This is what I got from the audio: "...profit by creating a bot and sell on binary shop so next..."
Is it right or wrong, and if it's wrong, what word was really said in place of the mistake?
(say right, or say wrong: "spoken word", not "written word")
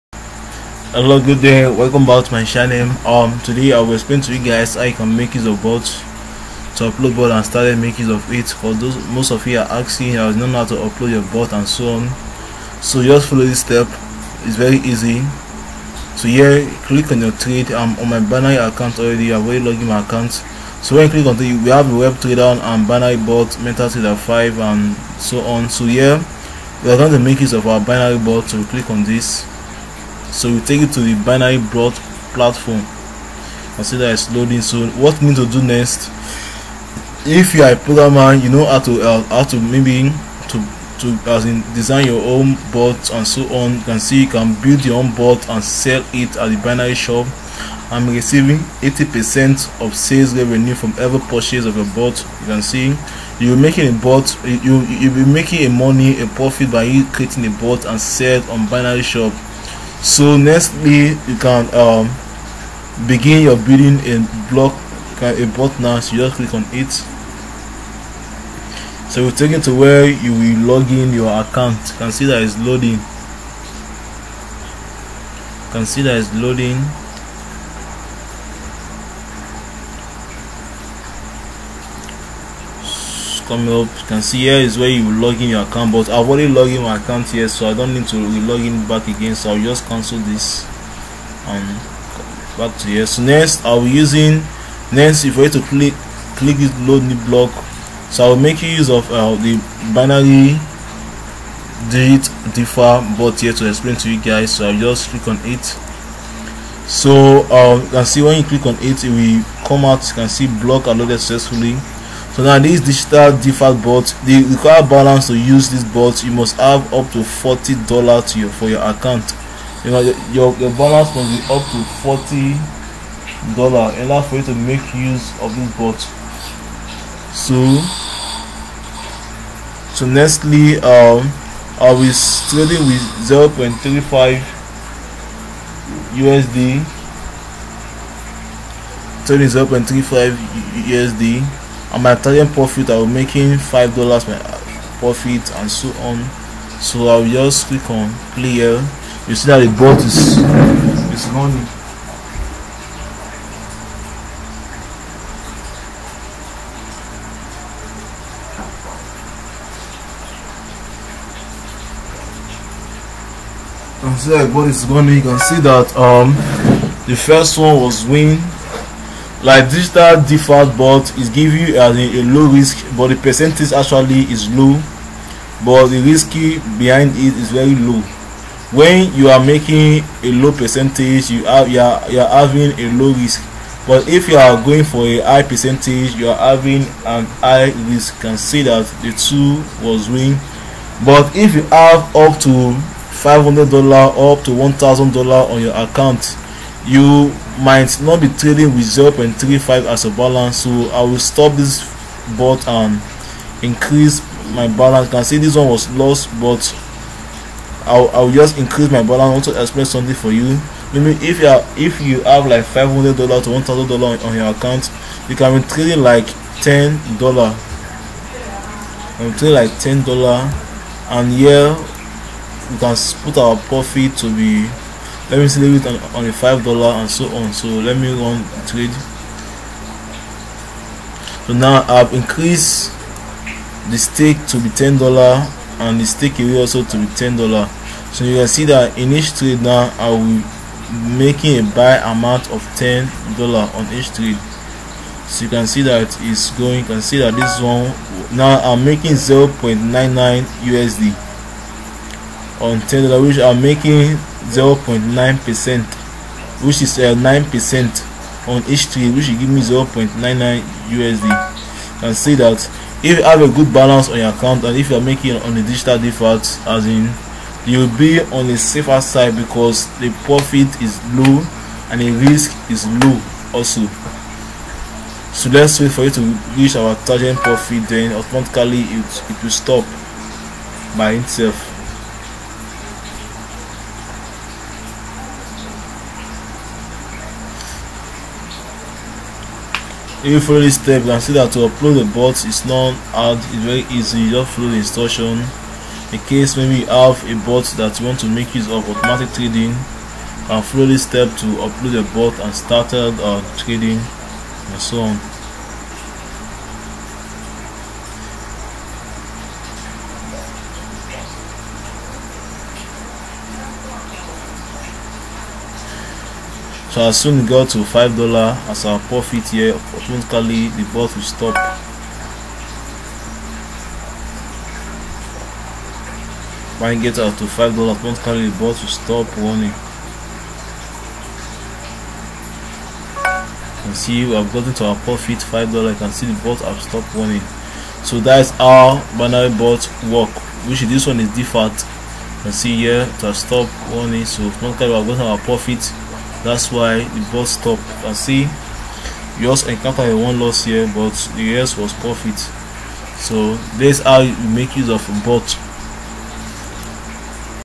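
right.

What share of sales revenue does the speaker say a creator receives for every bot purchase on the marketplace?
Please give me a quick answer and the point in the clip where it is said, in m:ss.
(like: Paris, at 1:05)
80 percent, at 0:48.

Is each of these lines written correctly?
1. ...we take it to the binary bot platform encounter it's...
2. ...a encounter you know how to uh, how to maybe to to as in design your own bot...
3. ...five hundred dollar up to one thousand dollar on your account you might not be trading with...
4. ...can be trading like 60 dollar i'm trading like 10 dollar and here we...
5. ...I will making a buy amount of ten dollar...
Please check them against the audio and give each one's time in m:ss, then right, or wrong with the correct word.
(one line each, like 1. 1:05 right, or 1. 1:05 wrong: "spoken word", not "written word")
1. 0:30 wrong: "consider", not "encounter"
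2. 0:37 wrong: "programmer", not "encounter"
3. 3:13 right
4. 3:35 wrong: "10", not "60"
5. 3:59 right.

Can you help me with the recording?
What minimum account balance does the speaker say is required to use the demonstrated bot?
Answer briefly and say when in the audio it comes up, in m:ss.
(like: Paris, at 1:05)
40 dollars, at 1:57.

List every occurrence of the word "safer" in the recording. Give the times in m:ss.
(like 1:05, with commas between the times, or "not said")
4:28.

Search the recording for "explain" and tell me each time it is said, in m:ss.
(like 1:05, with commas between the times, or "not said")
0:03, 1:43, 3:29.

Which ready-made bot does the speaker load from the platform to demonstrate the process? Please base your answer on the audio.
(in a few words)
binary digit differ.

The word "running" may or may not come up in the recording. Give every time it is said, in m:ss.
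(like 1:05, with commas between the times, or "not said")
2:31, 2:44.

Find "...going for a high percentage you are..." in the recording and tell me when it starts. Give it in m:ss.
3:04.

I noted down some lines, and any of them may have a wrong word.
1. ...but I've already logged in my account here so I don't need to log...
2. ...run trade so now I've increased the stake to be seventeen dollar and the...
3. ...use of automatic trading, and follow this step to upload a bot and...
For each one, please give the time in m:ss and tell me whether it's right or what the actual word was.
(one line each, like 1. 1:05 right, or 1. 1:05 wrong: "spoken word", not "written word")
1. 1:25 right
2. 3:48 wrong: "ten", not "seventeen"
3. 4:58 right.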